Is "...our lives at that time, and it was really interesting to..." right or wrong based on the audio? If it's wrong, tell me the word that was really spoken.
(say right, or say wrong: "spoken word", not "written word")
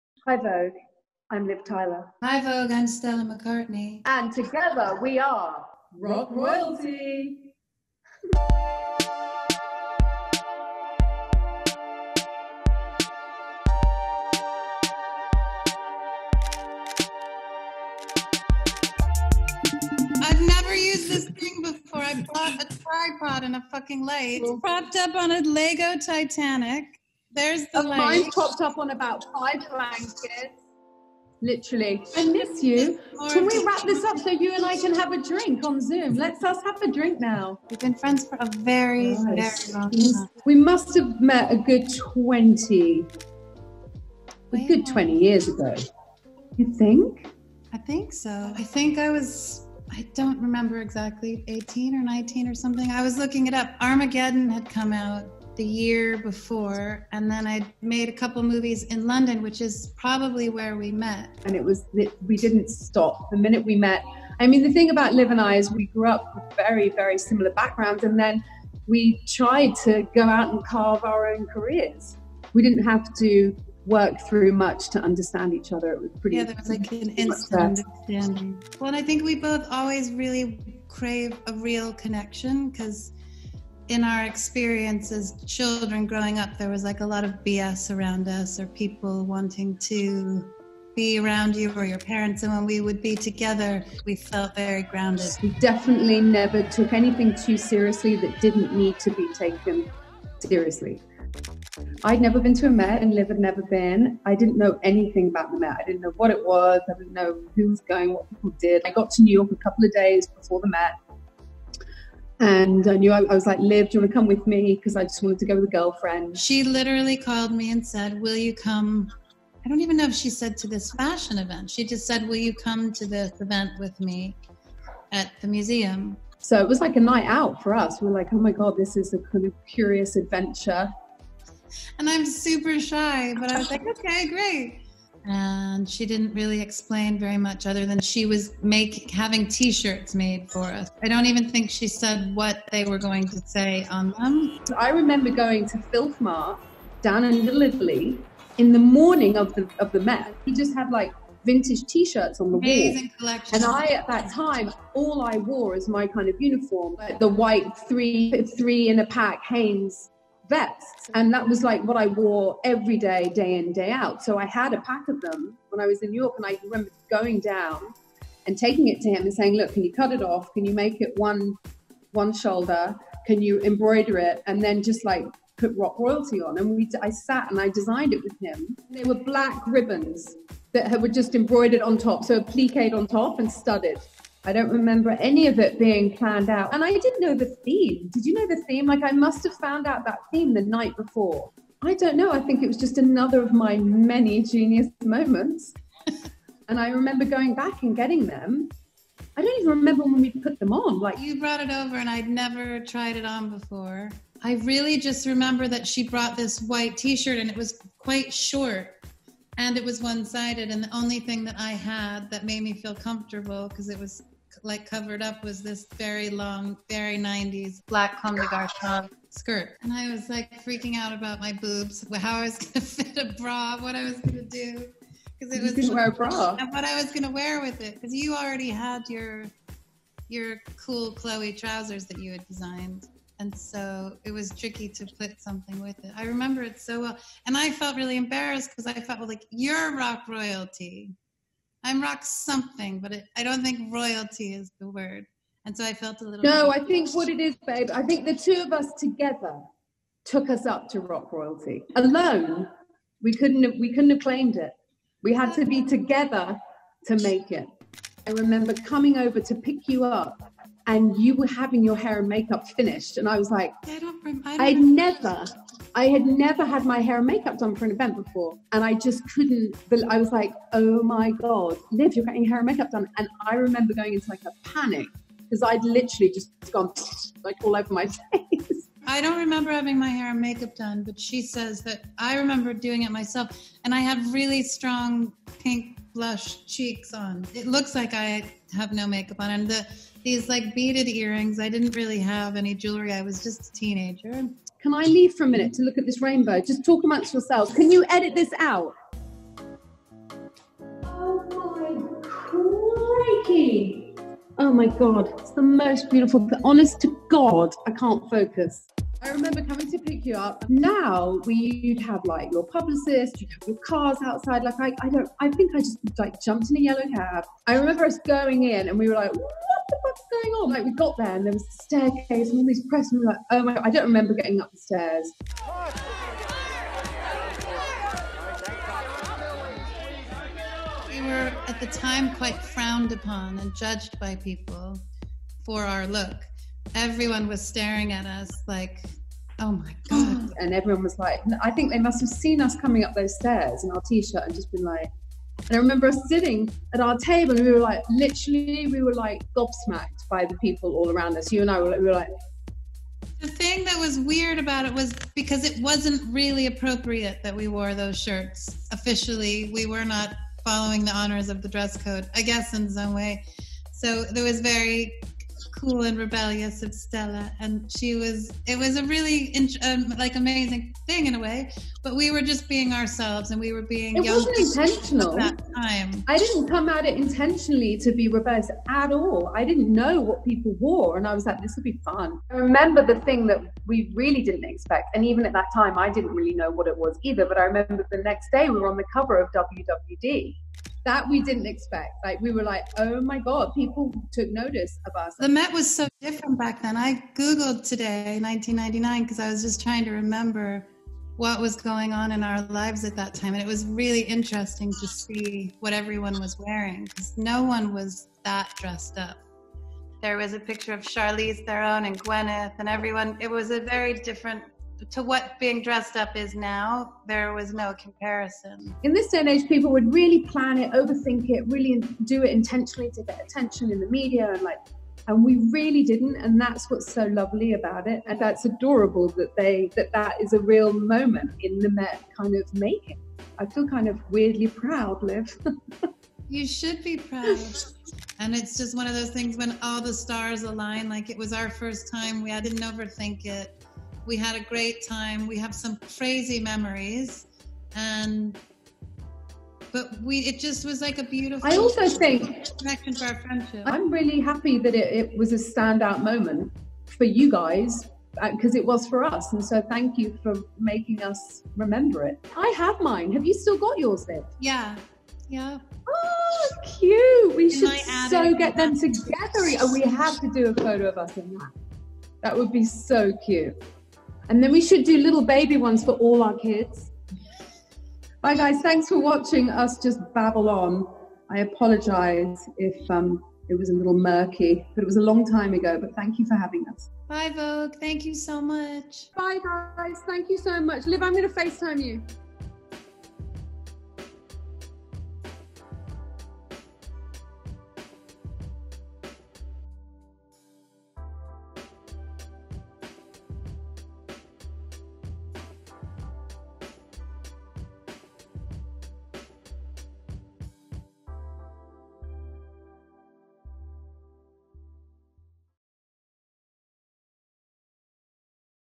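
right.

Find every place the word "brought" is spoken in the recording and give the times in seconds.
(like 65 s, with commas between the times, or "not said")
201 s, 206 s.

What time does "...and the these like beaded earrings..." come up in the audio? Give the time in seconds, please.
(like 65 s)
289 s.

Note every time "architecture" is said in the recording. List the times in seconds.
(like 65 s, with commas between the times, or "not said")
not said.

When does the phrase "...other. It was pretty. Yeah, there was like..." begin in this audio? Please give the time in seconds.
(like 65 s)
75 s.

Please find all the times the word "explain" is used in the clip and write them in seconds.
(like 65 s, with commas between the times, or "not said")
136 s.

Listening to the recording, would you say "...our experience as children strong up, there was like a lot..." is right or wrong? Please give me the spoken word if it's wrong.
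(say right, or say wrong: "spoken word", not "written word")
wrong: "growing", not "strong".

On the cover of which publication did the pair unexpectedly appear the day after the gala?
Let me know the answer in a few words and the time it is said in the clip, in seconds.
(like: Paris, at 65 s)
WWD, at 389 s.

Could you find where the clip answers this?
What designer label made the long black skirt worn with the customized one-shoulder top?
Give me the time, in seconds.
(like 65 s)
218 s.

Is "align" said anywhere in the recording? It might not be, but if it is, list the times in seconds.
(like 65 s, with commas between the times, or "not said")
440 s.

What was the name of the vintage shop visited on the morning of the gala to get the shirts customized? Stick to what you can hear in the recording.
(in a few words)
Filth Mart.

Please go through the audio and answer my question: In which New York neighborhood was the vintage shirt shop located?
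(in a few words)
Little Italy.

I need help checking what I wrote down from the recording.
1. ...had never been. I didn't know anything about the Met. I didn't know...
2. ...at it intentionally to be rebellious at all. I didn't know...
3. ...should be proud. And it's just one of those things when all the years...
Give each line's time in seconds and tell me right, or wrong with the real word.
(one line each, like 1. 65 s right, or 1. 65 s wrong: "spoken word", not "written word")
1. 103 s right
2. 376 s right
3. 436 s wrong: "stars", not "years".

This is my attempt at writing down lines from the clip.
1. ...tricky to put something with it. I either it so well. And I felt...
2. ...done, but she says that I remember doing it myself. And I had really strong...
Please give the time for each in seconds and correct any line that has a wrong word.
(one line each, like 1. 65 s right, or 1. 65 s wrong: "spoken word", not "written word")
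1. 234 s wrong: "remember", not "either"
2. 280 s right.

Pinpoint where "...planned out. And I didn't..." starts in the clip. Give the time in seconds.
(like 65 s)
186 s.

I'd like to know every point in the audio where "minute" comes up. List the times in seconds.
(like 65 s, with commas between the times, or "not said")
63 s, 295 s.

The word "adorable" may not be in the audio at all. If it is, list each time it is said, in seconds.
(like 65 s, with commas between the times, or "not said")
428 s.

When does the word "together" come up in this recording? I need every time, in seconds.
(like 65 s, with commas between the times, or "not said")
4 s, 93 s, 248 s, 255 s, 468 s.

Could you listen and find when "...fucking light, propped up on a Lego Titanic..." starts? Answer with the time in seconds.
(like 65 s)
23 s.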